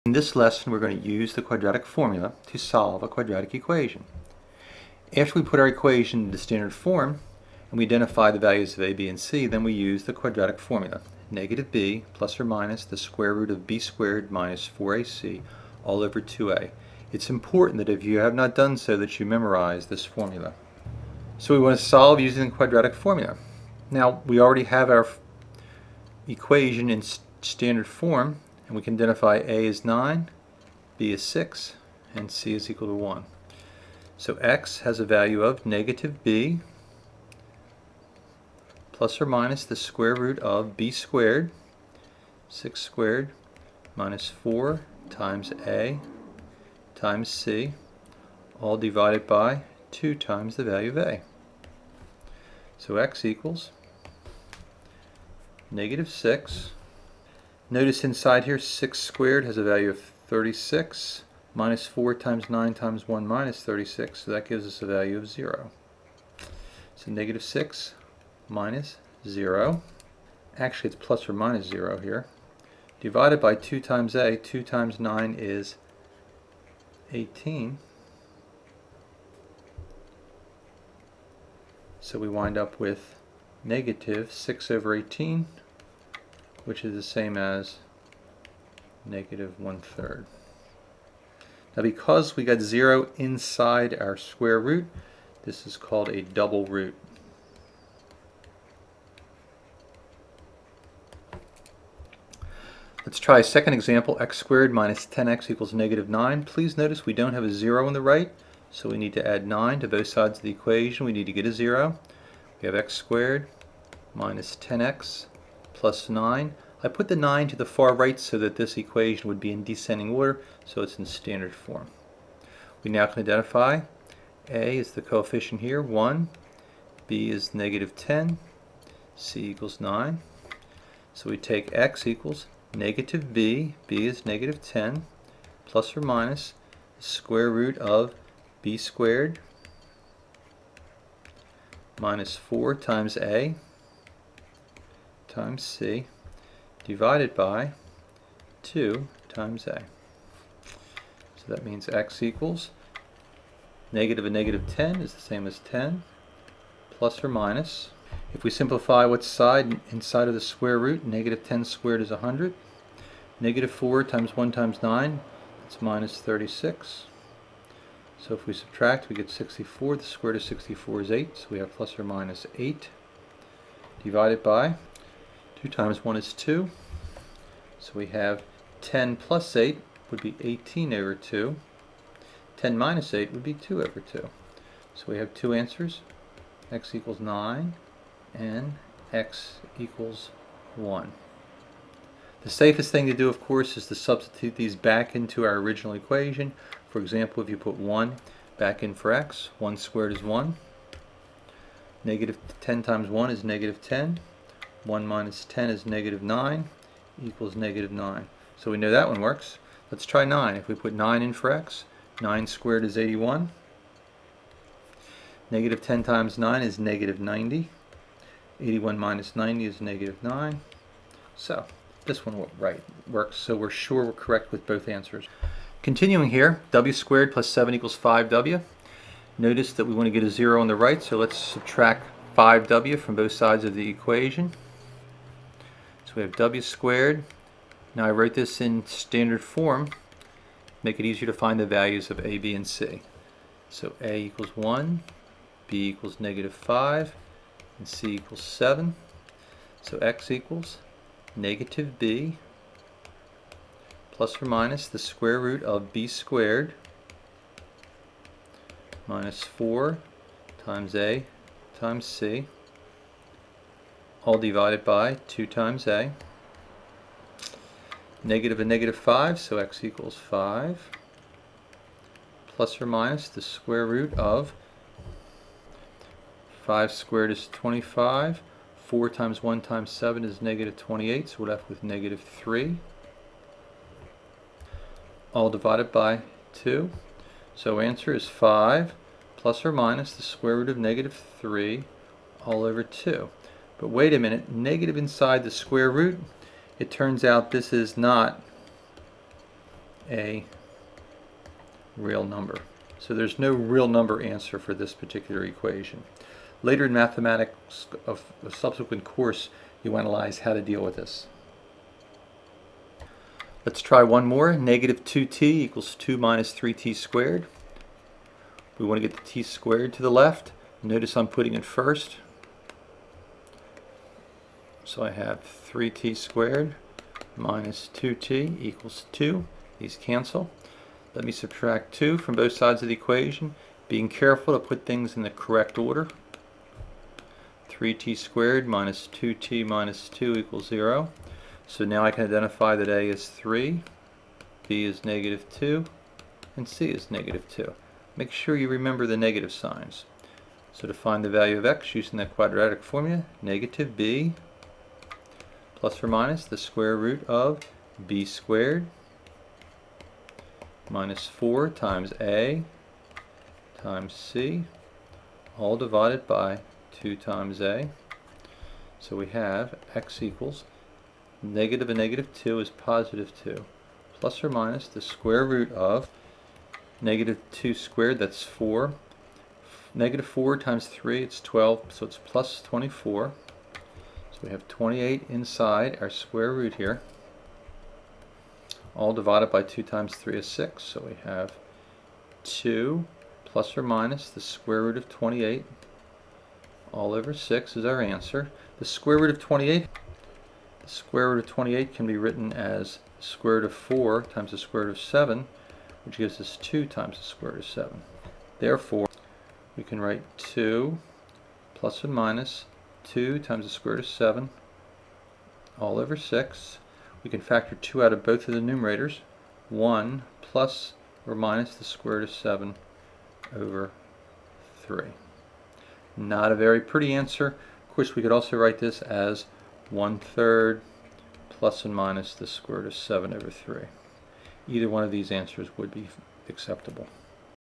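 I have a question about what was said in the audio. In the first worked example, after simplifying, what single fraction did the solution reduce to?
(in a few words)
-1/3.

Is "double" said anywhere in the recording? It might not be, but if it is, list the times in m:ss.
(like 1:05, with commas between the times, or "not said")
1:36.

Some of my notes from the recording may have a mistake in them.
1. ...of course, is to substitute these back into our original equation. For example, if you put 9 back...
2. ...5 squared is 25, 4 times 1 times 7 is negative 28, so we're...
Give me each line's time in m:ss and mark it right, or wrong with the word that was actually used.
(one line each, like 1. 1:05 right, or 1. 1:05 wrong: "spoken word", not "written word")
1. 3:13 wrong: "1", not "9"
2. 4:36 right.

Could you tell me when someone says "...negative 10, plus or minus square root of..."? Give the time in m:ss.
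2:14.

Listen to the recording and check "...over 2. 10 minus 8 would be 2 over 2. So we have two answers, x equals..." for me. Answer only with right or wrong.
right.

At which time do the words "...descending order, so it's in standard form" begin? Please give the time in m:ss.
1:59.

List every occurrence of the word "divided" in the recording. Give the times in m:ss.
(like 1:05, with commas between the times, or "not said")
0:48, 1:12, 2:26, 2:54, 4:24, 4:45, 6:05, 6:29.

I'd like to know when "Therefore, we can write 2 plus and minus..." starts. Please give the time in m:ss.
6:48.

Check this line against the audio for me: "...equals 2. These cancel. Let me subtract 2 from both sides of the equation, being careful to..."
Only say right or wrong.
right.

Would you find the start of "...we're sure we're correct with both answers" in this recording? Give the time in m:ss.
3:43.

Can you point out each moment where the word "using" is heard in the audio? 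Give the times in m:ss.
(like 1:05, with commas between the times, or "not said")
0:22, 5:51.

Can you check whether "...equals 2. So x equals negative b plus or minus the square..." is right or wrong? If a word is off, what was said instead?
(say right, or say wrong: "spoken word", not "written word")
wrong: "7", not "2".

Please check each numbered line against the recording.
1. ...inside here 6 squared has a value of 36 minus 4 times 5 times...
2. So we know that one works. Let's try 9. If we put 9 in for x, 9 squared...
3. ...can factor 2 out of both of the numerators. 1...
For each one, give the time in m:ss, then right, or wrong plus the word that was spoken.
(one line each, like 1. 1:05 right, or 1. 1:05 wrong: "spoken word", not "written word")
1. 0:58 wrong: "9", not "5"
2. 3:28 right
3. 6:57 right.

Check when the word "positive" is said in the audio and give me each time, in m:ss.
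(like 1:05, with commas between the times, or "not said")
6:12.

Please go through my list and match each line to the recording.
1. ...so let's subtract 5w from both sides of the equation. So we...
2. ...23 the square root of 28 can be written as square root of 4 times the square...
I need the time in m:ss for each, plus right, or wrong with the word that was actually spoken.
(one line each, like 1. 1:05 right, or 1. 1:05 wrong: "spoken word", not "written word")
1. 3:51 right
2. 6:39 wrong: "28", not "23".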